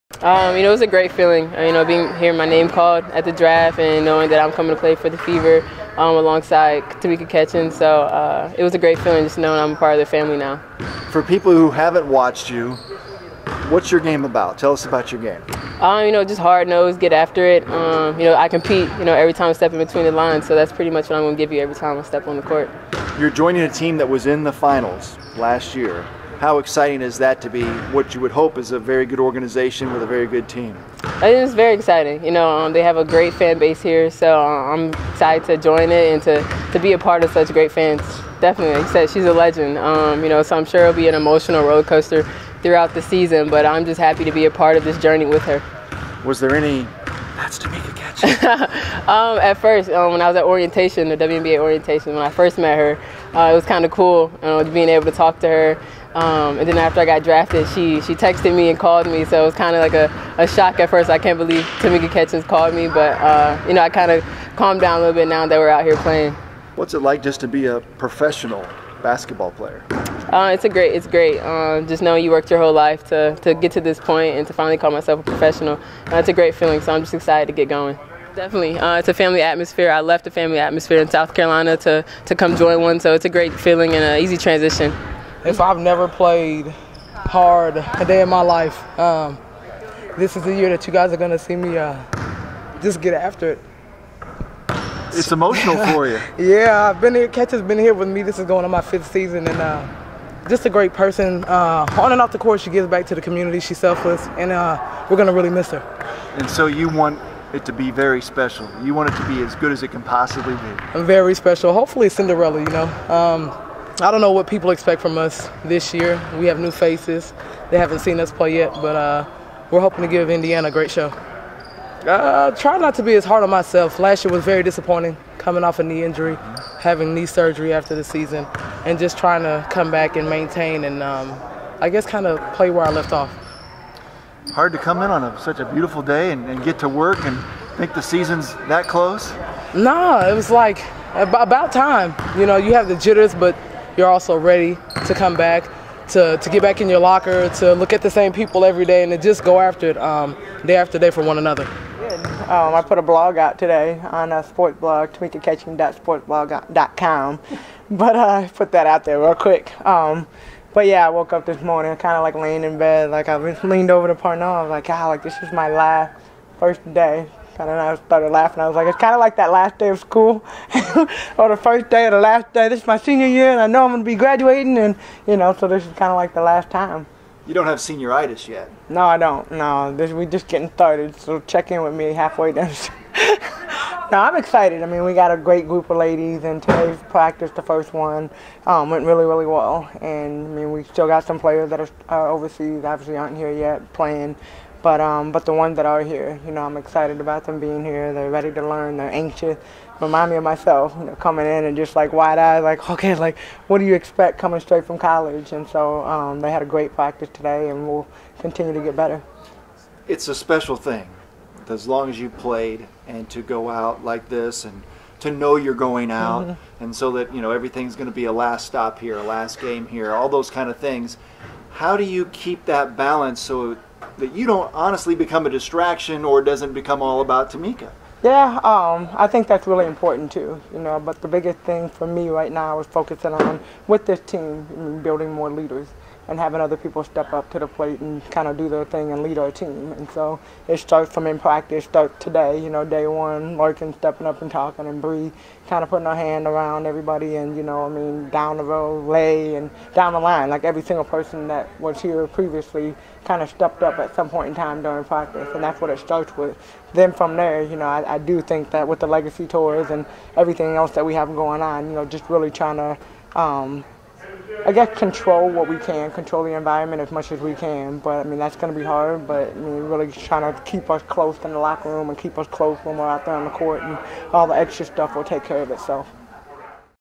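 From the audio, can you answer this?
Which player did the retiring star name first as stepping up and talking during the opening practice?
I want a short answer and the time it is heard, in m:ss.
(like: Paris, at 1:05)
Larkin, at 4:03.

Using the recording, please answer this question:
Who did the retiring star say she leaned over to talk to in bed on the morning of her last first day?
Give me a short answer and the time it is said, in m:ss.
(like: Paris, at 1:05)
Parnell, at 2:44.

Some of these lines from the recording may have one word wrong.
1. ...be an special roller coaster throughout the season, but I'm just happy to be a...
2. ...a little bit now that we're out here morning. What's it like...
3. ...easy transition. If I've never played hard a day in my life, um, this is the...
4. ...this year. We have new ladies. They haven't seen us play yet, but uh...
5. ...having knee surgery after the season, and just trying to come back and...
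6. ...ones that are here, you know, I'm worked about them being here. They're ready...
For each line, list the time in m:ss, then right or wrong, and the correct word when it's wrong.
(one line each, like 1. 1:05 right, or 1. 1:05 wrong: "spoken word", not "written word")
1. 0:40 wrong: "emotional", not "special"
2. 1:04 wrong: "playing", not "morning"
3. 1:24 right
4. 1:55 wrong: "faces", not "ladies"
5. 2:06 right
6. 3:15 wrong: "excited", not "worked".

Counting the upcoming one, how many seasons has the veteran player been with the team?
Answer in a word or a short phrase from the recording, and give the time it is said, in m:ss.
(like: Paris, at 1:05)
5, at 1:38.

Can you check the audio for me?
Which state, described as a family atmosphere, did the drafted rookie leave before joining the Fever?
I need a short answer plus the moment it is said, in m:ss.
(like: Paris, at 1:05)
South Carolina, at 1:21.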